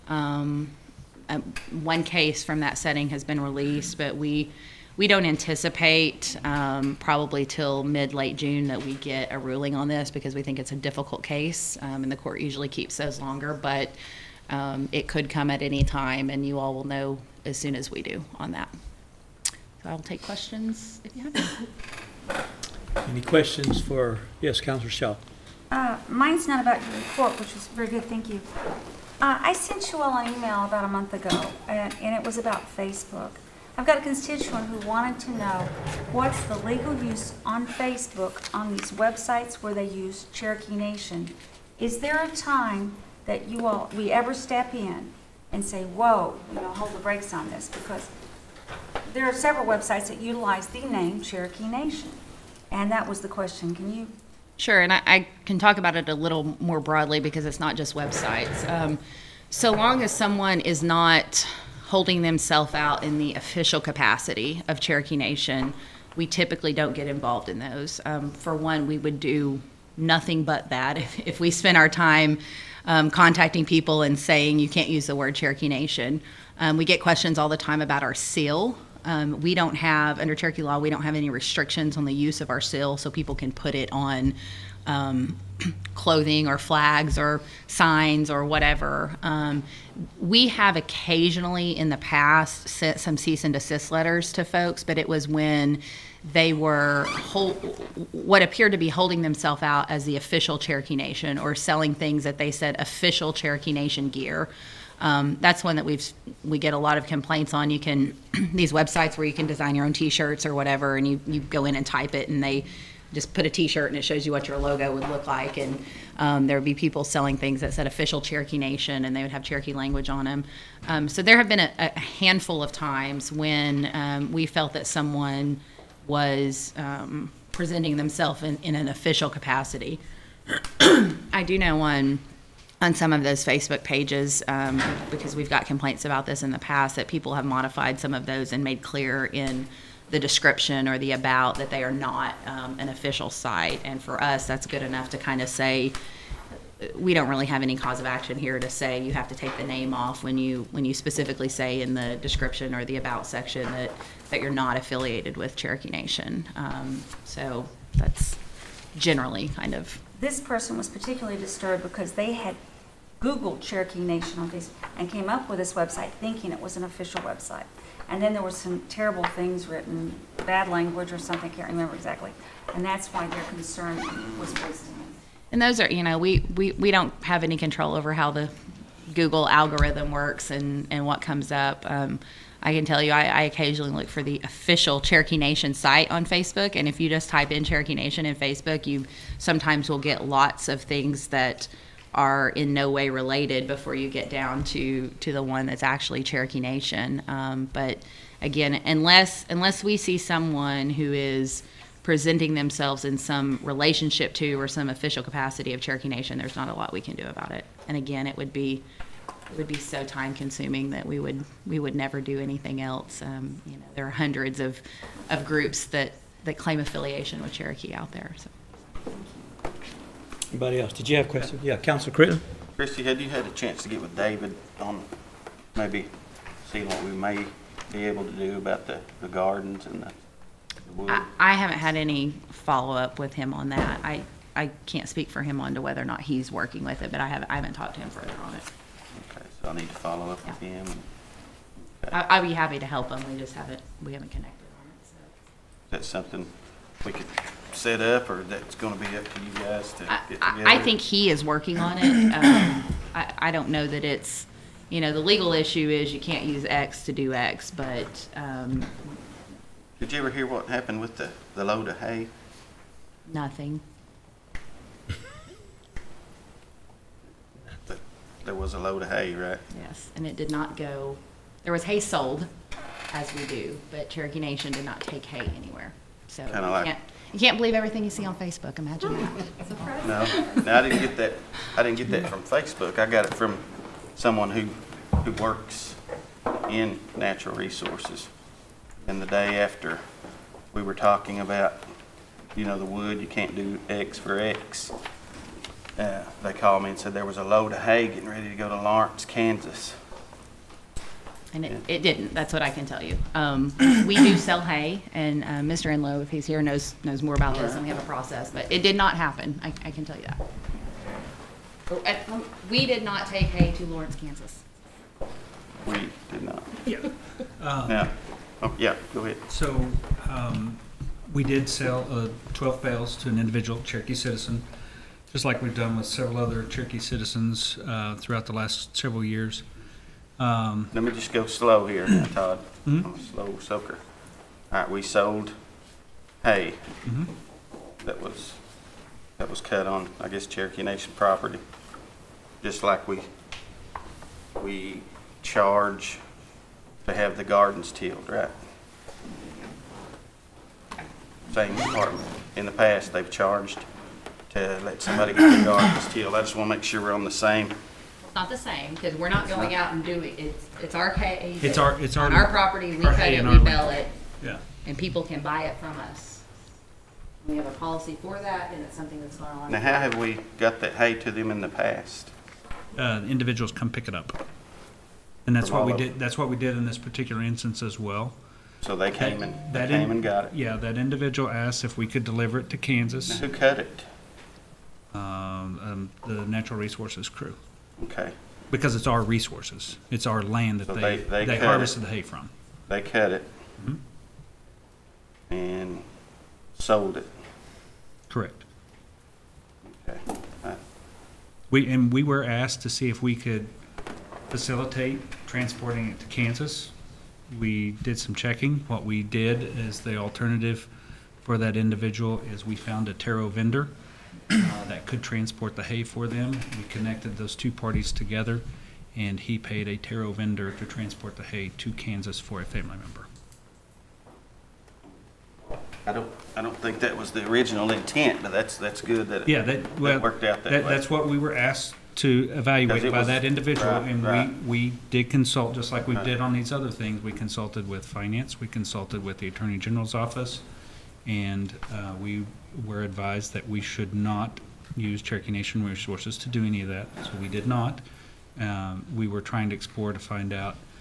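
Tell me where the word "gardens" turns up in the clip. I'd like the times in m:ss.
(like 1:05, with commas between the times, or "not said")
3:49, 5:47, 5:55.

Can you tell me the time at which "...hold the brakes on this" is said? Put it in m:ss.
0:46.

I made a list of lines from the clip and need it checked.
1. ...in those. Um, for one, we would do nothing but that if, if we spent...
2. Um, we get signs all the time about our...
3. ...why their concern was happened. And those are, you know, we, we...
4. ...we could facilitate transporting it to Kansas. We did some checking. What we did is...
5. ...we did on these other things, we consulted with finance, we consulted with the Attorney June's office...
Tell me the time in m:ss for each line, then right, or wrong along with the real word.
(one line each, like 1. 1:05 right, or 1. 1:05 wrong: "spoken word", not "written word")
1. 1:07 right
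2. 1:16 wrong: "questions", not "signs"
3. 2:53 wrong: "wasted", not "happened"
4. 6:43 right
5. 7:16 wrong: "General", not "June".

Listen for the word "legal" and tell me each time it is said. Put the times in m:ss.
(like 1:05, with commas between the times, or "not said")
0:36, 4:15.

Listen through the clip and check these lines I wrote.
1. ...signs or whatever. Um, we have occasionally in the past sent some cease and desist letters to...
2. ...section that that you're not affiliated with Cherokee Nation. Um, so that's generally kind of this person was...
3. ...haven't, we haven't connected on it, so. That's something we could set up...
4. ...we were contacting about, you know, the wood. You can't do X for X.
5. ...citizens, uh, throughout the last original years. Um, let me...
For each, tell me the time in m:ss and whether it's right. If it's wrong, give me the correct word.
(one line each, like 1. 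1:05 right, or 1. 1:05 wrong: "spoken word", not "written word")
1. 1:27 right
2. 2:33 right
3. 4:03 right
4. 4:50 wrong: "talking", not "contacting"
5. 5:26 wrong: "several", not "original".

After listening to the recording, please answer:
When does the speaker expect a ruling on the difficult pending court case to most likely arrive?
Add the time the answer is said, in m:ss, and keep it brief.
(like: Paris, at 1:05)
mid late June, at 0:07.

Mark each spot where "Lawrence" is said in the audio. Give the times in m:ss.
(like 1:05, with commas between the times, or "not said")
4:58, 5:13.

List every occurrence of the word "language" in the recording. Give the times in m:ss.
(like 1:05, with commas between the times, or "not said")
1:59, 2:50.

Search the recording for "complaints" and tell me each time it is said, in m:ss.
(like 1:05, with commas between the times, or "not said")
1:47, 2:15.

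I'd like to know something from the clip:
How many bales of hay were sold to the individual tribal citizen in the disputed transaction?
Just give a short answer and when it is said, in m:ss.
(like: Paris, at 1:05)
12, at 5:22.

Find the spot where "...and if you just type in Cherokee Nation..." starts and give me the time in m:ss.
3:06.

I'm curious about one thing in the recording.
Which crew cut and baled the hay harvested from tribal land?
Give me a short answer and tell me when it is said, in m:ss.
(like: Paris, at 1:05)
natural resources crew, at 6:26.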